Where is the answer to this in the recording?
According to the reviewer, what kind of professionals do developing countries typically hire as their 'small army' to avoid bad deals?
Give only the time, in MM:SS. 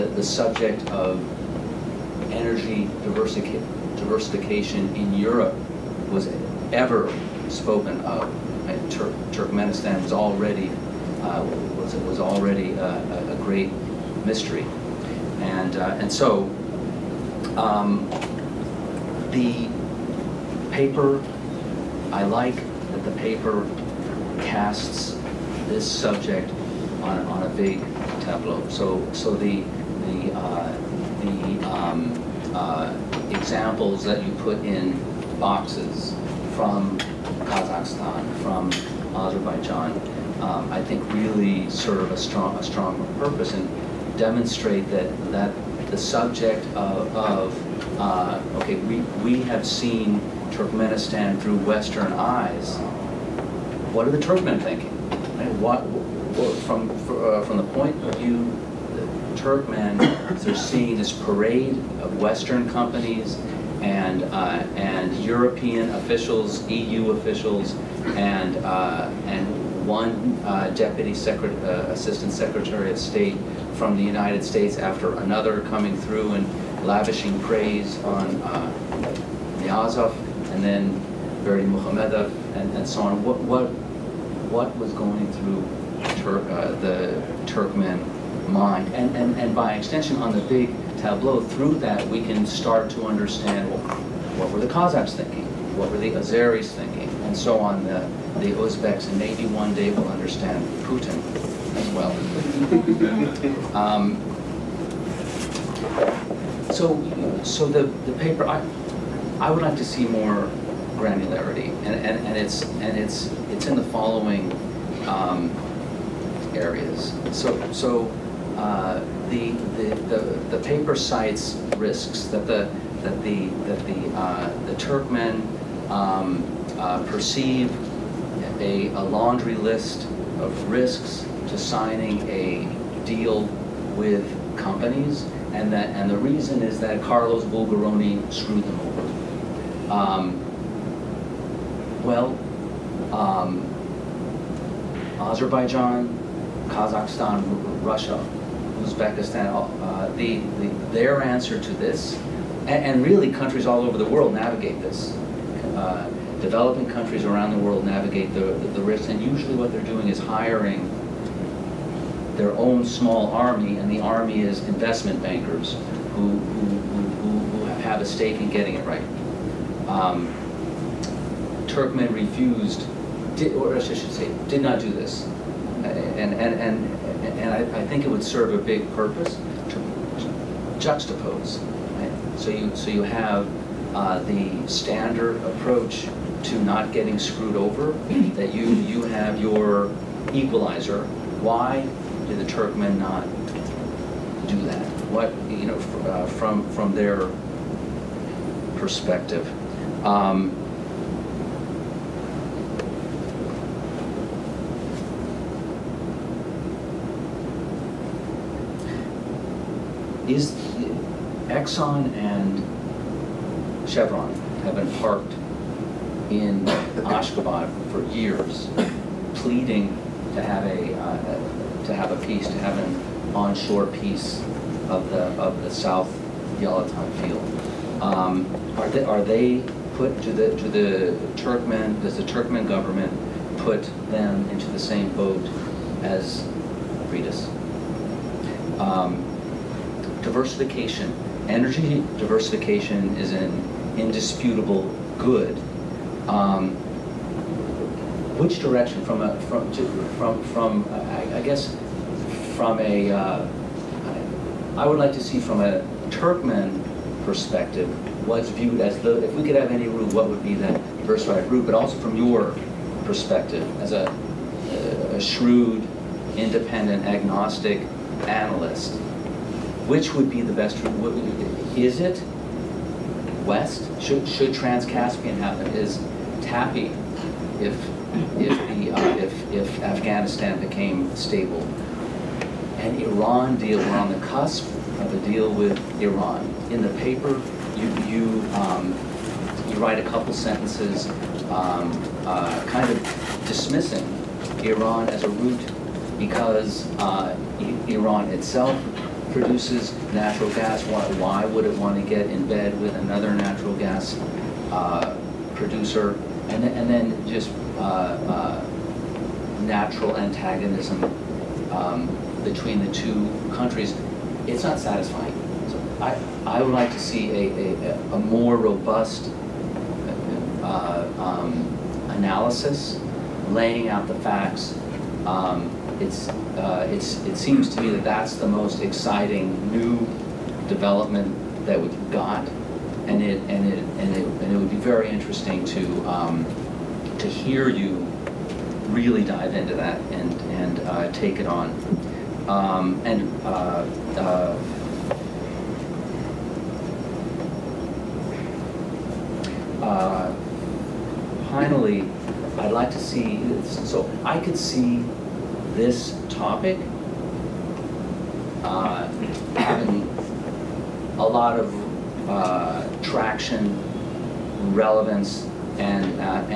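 02:44.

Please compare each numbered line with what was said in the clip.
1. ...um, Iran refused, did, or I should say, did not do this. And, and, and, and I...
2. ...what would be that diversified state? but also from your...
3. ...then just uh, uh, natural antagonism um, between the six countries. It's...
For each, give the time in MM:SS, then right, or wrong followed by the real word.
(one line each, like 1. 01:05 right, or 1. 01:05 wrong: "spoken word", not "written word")
1. 02:49 wrong: "Turkmen", not "Iran"
2. 04:20 wrong: "route", not "state"
3. 05:06 wrong: "two", not "six".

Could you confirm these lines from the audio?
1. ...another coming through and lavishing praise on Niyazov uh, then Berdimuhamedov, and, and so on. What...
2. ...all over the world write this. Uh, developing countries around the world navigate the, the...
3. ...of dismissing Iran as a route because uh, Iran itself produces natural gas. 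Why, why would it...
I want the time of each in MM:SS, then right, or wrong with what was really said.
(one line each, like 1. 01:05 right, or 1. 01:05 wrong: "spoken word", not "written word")
1. 01:15 right
2. 02:33 wrong: "navigate", not "write"
3. 04:52 right.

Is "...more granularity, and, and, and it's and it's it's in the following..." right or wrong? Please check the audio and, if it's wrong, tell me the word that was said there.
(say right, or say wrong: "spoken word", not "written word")
right.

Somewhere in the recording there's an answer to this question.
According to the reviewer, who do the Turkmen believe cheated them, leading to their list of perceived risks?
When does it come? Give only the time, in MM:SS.
02:17.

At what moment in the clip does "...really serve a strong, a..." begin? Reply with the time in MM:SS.
00:41.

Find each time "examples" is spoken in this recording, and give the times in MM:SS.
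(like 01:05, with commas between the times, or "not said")
00:33.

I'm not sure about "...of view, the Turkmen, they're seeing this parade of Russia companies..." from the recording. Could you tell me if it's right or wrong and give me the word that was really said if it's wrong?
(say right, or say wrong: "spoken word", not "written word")
wrong: "Western", not "Russia".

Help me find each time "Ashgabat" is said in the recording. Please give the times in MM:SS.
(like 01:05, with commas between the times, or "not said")
03:37.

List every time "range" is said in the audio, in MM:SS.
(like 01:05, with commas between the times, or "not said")
not said.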